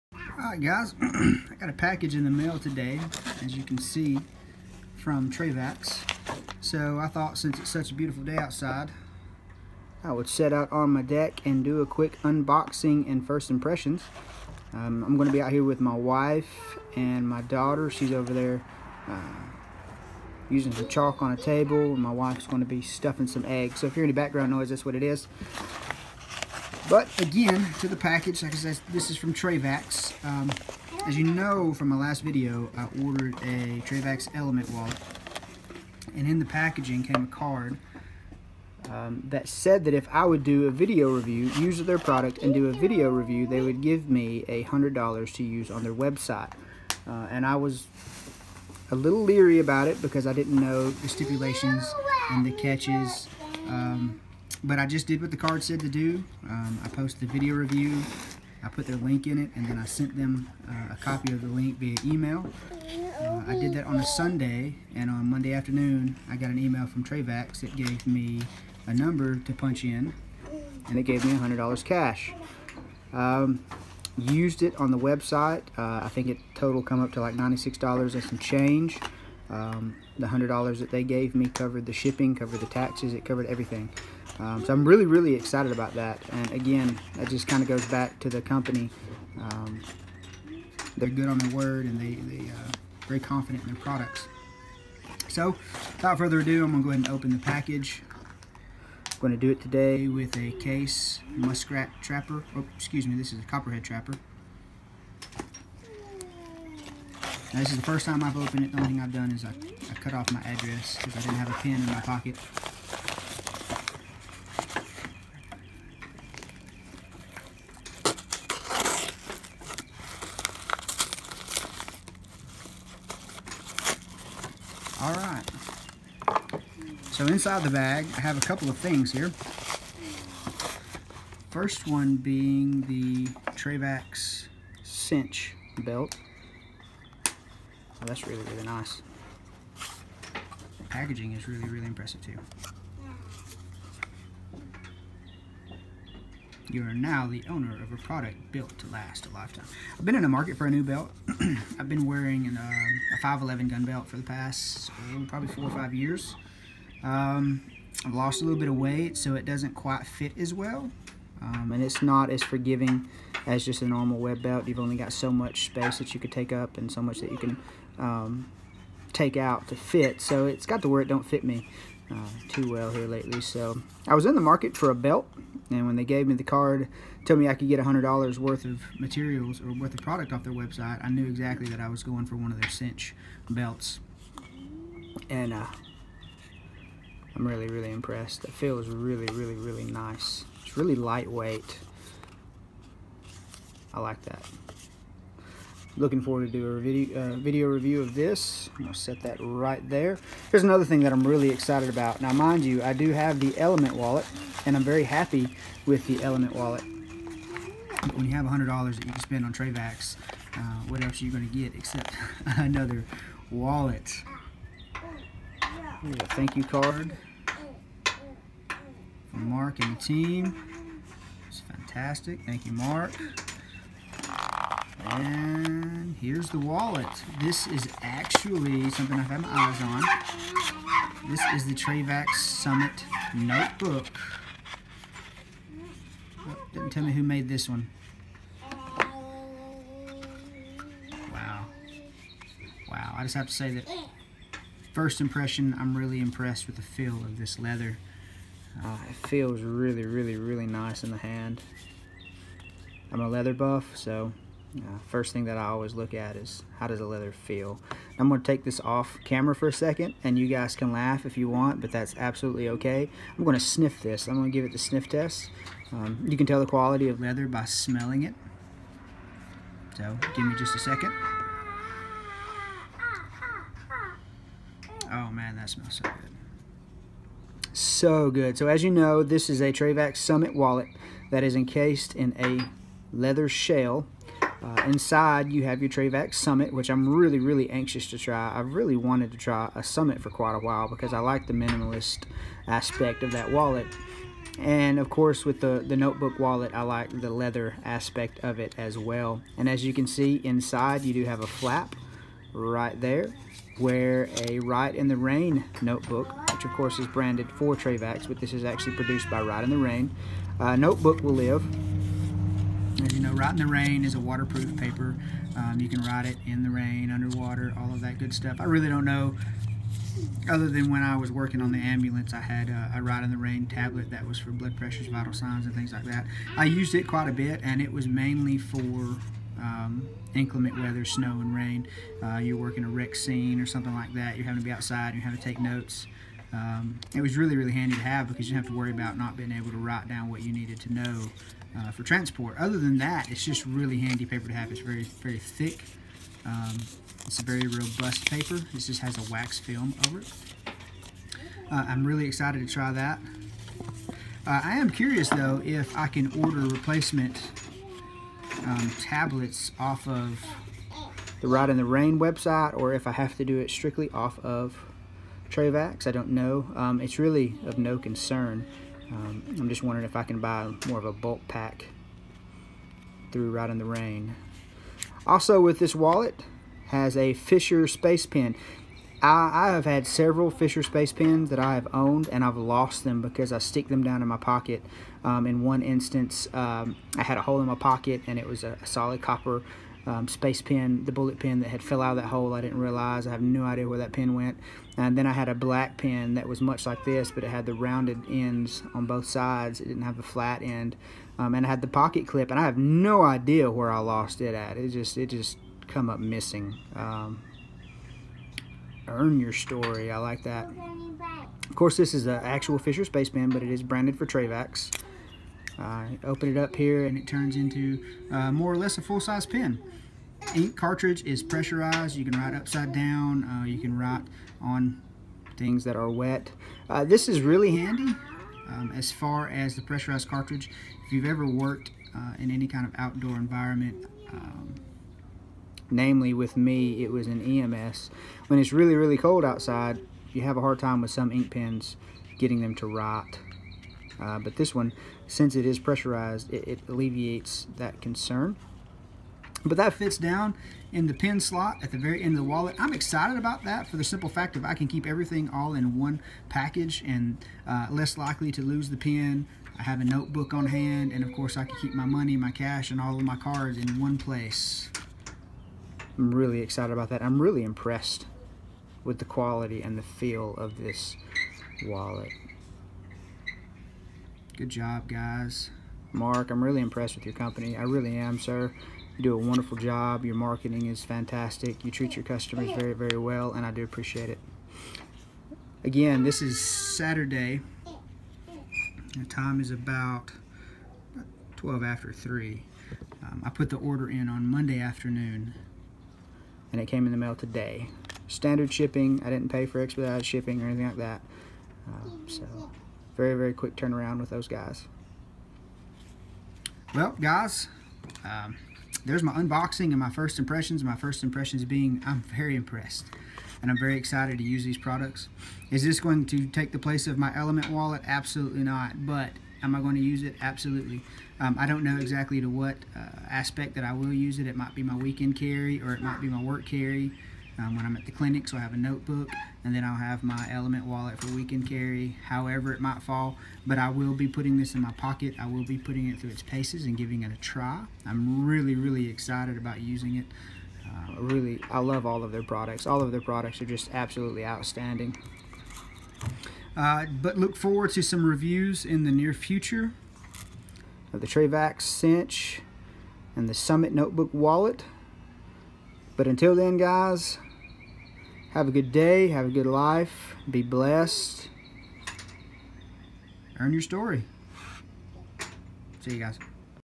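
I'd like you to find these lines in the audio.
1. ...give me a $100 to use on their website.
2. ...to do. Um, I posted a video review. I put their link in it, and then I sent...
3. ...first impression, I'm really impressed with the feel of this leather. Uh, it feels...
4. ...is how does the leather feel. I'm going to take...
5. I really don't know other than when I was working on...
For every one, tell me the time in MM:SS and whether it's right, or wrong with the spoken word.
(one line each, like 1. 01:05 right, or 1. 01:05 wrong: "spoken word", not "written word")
1. 00:43 right
2. 00:55 right
3. 04:04 right
4. 04:16 right
5. 05:18 right.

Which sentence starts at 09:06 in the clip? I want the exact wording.
Uh, but look forward to some reviews in the near future of the Trayvax cinch and the Summit Notebook Wallet.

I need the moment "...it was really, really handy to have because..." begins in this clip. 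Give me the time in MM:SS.
05:37.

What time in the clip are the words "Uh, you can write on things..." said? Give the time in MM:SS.
07:03.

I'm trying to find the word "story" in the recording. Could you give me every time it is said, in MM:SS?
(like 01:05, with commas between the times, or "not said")
06:49, 09:23.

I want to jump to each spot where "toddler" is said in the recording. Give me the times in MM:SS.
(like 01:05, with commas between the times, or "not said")
not said.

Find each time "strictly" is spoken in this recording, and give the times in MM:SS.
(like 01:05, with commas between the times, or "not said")
06:03.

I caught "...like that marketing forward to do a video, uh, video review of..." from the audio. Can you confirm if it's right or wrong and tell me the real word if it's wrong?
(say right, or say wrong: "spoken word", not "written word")
wrong: "looking", not "marketing".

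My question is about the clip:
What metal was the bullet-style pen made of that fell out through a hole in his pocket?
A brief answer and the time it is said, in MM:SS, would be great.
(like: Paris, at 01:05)
Copper, at 06:29.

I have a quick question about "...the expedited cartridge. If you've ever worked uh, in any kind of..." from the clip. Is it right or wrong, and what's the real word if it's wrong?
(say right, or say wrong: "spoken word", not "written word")
wrong: "pressurized", not "expedited".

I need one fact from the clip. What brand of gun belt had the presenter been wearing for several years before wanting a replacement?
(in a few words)
511.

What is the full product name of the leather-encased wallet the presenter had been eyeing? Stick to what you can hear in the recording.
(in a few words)
Trayvax Summit Notebook.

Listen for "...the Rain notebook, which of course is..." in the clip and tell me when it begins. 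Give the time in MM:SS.
05:05.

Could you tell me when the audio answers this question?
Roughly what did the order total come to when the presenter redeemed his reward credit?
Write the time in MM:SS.
01:17.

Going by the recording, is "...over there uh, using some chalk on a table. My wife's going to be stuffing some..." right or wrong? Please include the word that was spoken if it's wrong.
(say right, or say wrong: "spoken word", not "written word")
right.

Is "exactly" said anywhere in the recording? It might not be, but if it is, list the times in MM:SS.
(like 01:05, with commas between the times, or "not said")
03:01, 08:41.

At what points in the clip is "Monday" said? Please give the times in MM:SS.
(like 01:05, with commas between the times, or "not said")
01:05, 08:14.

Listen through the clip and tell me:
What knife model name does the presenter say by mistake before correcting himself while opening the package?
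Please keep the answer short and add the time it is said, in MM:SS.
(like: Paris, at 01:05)
Muskrat trapper, at 01:41.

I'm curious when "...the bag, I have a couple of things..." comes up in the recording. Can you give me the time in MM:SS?
02:07.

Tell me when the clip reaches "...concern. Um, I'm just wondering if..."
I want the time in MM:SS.
06:07.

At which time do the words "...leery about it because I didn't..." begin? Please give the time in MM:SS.
00:49.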